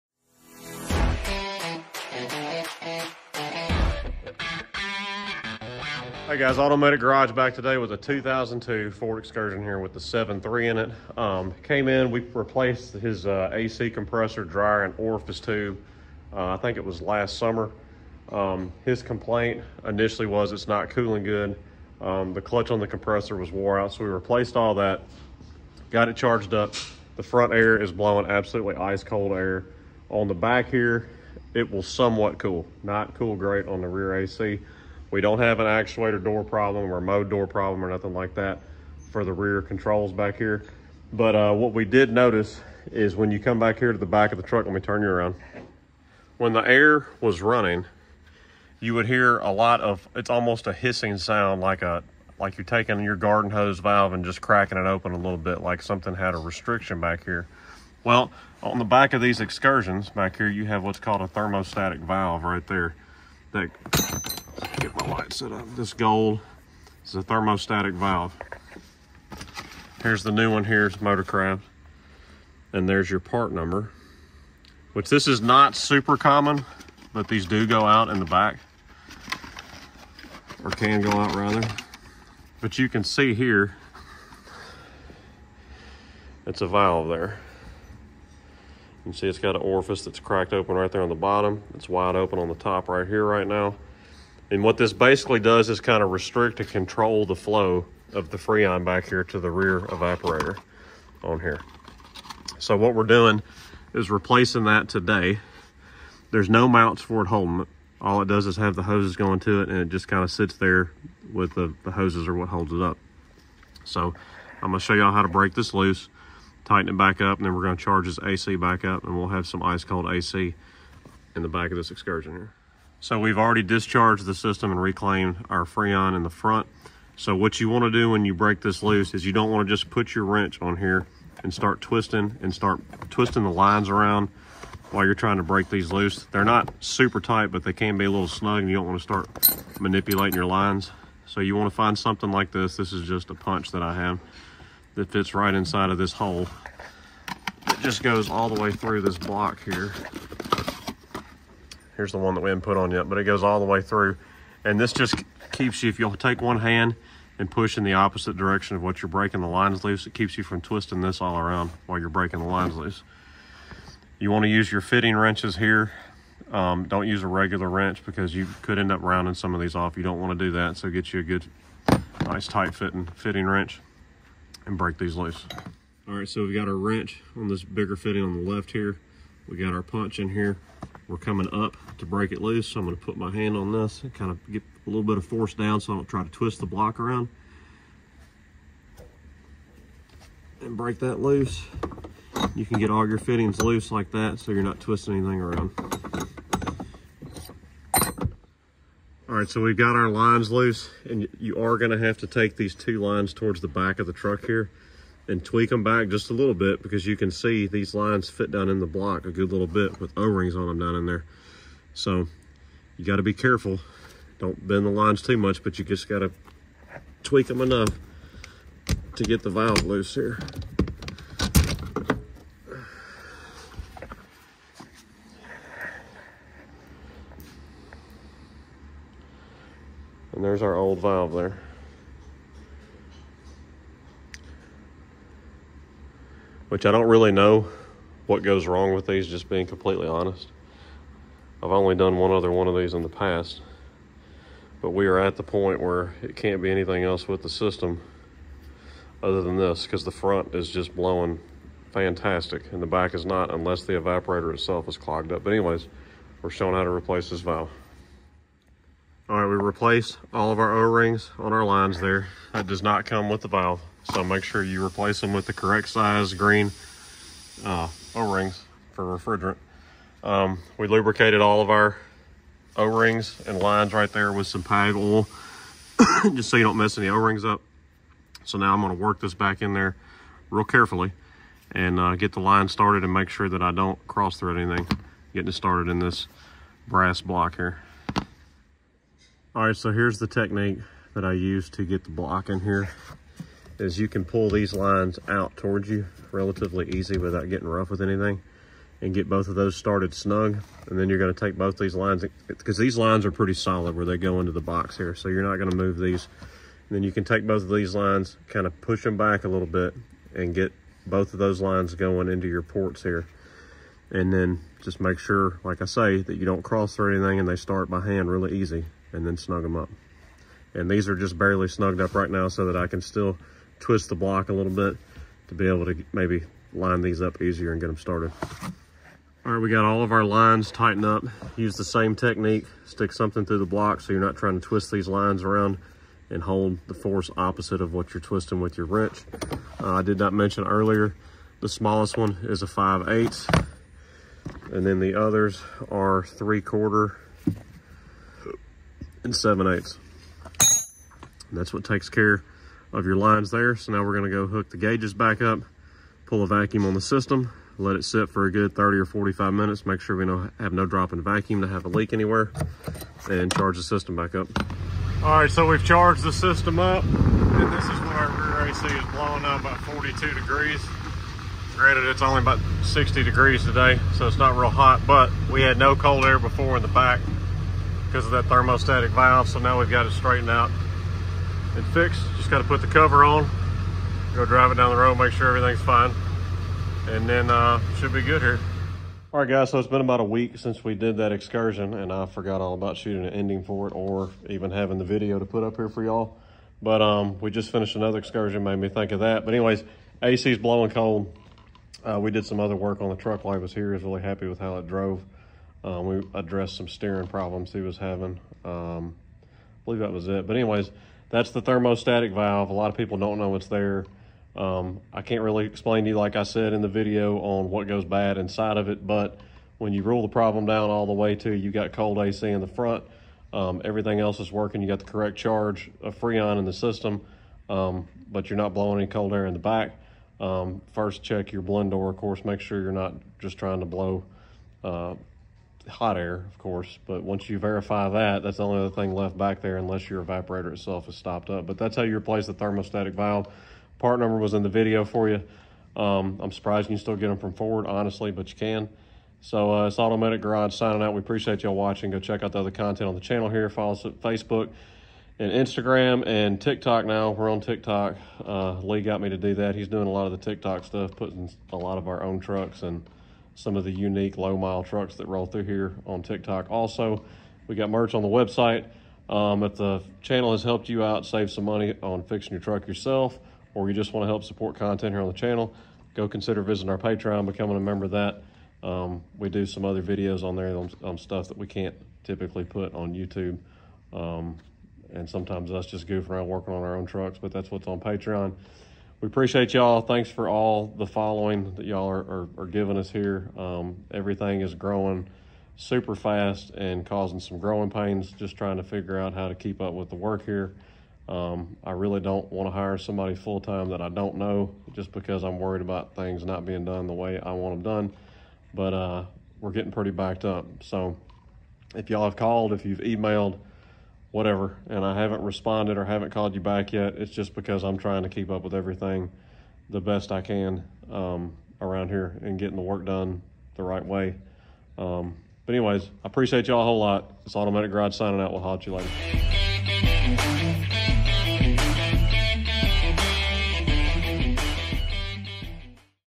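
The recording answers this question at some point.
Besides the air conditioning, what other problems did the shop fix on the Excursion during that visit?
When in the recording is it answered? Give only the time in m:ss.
6:46.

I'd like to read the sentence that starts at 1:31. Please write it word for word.
It's wide open on the top right here right now.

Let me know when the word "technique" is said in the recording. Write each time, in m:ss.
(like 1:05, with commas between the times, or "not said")
4:50, 5:32.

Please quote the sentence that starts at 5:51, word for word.
And that's what takes care of your lines there.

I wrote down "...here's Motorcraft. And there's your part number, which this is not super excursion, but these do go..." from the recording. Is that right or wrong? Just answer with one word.
wrong.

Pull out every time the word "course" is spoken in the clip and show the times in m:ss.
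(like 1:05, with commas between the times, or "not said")
7:12, 7:16.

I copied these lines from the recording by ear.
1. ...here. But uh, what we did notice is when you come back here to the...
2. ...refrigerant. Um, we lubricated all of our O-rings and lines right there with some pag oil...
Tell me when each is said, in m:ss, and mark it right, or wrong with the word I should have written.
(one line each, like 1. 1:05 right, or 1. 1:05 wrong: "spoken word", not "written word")
1. 0:40 right
2. 4:29 right.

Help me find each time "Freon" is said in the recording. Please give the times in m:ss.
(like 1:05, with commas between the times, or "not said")
1:38, 2:05, 7:06.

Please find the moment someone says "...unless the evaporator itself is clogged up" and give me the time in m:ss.
4:13.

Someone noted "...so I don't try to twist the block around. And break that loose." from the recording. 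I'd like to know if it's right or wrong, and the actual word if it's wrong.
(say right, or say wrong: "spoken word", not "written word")
right.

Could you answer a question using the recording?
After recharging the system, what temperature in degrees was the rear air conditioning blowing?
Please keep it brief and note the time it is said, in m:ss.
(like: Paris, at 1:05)
42, at 6:09.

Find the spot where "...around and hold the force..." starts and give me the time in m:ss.
5:35.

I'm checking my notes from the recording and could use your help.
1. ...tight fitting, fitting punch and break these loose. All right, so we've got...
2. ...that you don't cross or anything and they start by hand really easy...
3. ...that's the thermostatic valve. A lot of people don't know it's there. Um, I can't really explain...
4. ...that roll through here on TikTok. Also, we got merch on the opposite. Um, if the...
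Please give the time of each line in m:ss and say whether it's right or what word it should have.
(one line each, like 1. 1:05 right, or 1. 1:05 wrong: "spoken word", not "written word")
1. 2:52 wrong: "wrench", not "punch"
2. 5:16 right
3. 6:51 right
4. 7:45 wrong: "website", not "opposite".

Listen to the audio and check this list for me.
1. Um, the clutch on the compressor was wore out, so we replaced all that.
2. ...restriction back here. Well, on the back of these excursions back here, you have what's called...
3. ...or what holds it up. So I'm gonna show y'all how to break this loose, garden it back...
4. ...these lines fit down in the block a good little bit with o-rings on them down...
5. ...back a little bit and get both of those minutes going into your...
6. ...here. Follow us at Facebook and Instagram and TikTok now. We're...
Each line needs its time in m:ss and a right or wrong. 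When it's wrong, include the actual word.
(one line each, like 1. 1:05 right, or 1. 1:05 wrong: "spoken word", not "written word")
1. 0:21 right
2. 0:56 right
3. 1:52 wrong: "tighten", not "garden"
4. 3:27 right
5. 5:09 wrong: "lines", not "minutes"
6. 7:33 right.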